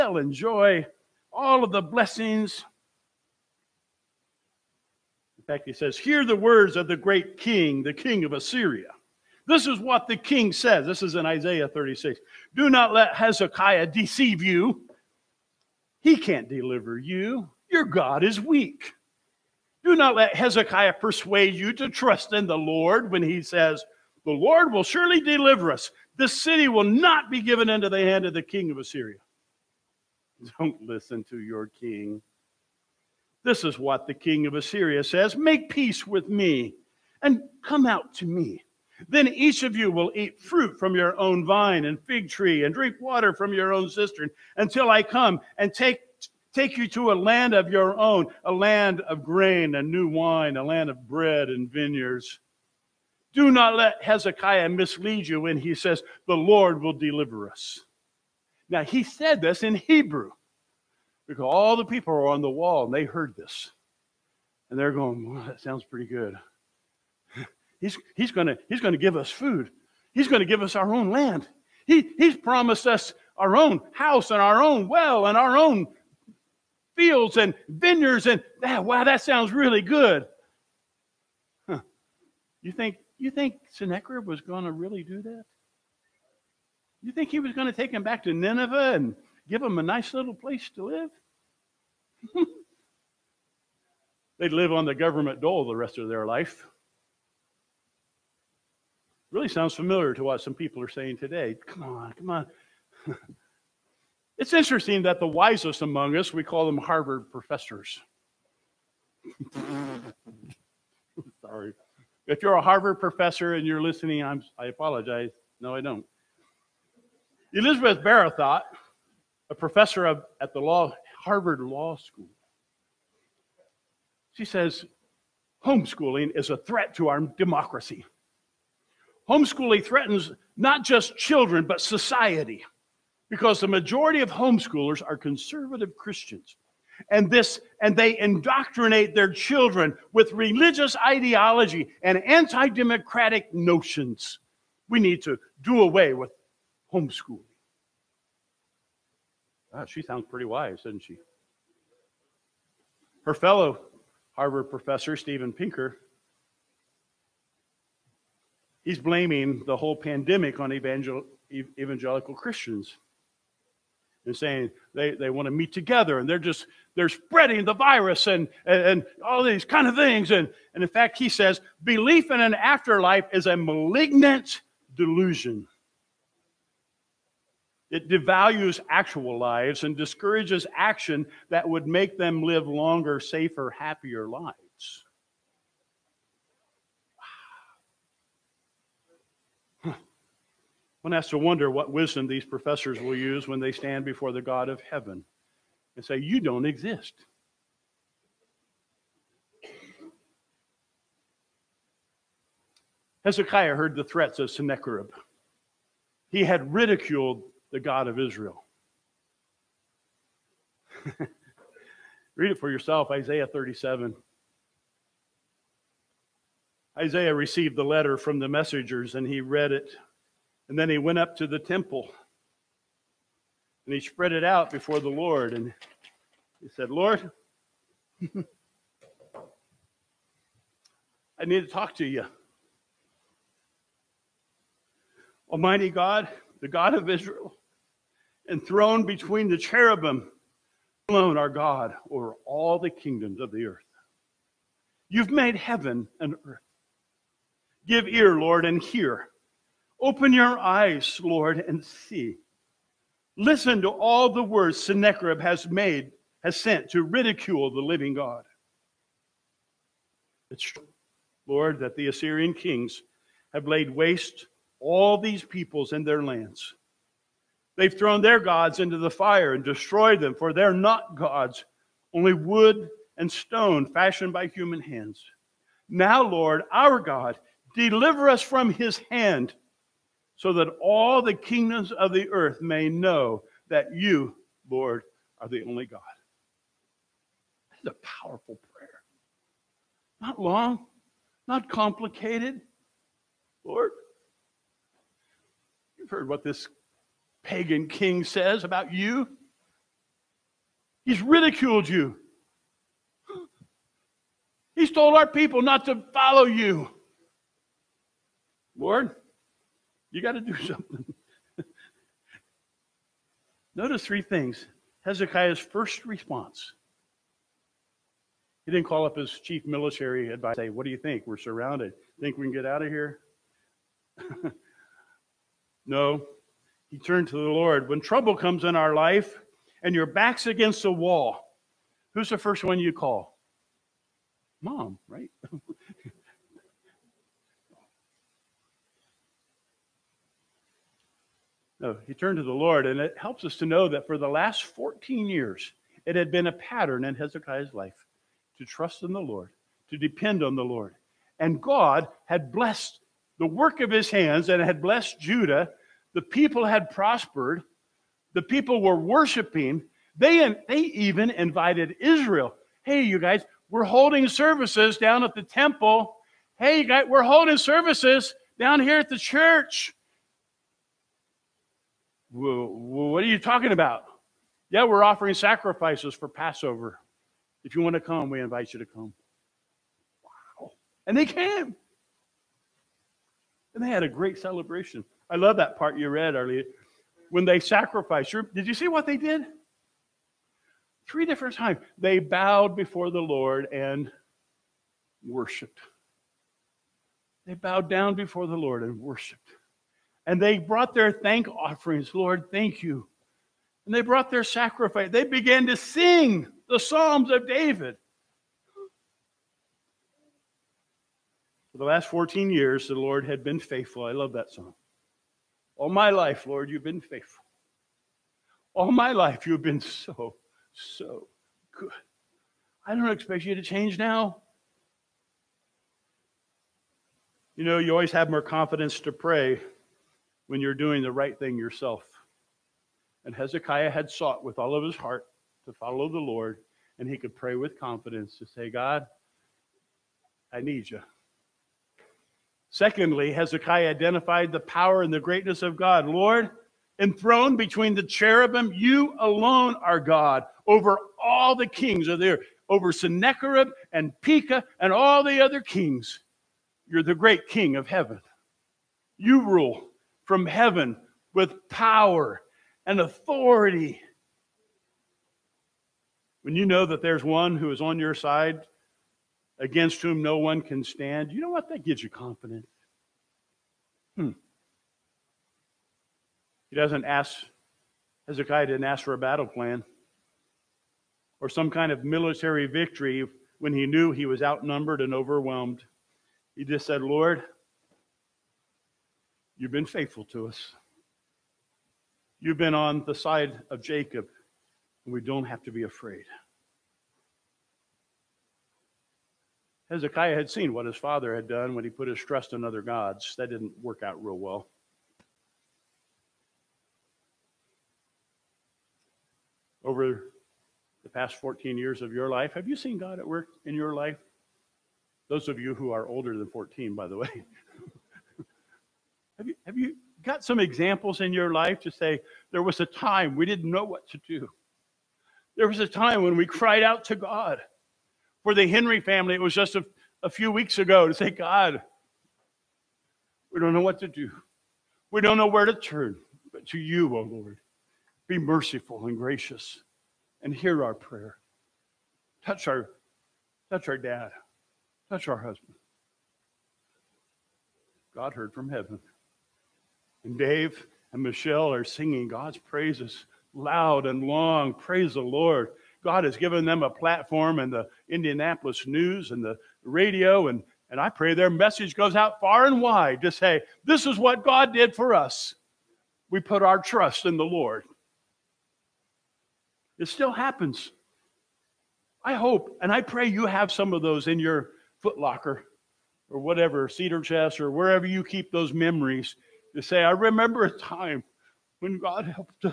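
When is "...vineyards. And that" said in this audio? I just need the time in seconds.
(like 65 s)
77 s.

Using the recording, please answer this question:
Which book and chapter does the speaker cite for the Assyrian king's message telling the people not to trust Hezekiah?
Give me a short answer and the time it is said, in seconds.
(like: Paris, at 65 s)
Isaiah 36, at 11 s.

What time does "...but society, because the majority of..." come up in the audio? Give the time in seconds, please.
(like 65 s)
131 s.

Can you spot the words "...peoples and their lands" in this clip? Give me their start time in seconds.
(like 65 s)
265 s.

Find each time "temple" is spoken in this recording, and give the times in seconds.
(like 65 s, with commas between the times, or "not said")
221 s, 365 s.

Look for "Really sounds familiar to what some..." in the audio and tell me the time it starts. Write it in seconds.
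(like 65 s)
99 s.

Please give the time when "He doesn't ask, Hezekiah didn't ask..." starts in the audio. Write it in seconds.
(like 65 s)
476 s.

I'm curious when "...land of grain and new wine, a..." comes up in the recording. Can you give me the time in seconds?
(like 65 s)
48 s.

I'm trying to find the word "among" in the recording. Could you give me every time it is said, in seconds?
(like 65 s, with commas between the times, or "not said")
105 s.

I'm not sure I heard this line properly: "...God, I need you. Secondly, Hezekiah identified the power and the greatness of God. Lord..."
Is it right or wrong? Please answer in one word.
right.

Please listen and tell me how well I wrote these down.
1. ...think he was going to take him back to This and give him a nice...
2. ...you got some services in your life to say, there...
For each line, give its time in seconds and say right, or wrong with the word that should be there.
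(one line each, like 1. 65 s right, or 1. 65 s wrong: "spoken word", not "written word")
1. 87 s wrong: "Nineveh", not "This"
2. 519 s wrong: "examples", not "services".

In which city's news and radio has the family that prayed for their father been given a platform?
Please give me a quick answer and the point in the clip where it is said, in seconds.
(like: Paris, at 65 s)
Indianapolis, at 558 s.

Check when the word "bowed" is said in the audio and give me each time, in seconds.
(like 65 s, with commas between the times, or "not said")
392 s, 397 s.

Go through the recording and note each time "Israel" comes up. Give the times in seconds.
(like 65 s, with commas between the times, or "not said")
208 s, 237 s, 361 s.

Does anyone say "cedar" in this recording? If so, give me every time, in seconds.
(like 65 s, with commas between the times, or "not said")
576 s.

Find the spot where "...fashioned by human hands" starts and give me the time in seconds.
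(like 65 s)
273 s.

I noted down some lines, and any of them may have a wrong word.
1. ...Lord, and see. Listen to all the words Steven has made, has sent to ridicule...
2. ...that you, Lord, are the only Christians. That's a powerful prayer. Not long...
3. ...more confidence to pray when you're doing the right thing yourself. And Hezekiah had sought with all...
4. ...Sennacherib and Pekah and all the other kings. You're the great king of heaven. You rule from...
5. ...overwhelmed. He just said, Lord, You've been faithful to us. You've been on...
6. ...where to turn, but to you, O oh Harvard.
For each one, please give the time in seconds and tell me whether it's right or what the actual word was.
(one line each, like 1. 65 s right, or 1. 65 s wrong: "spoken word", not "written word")
1. 251 s wrong: "Sennacherib", not "Steven"
2. 283 s wrong: "God", not "Christians"
3. 428 s right
4. 452 s right
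5. 485 s right
6. 535 s wrong: "Lord", not "Harvard".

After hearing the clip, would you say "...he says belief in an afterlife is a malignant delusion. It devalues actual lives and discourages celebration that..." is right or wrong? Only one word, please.
wrong.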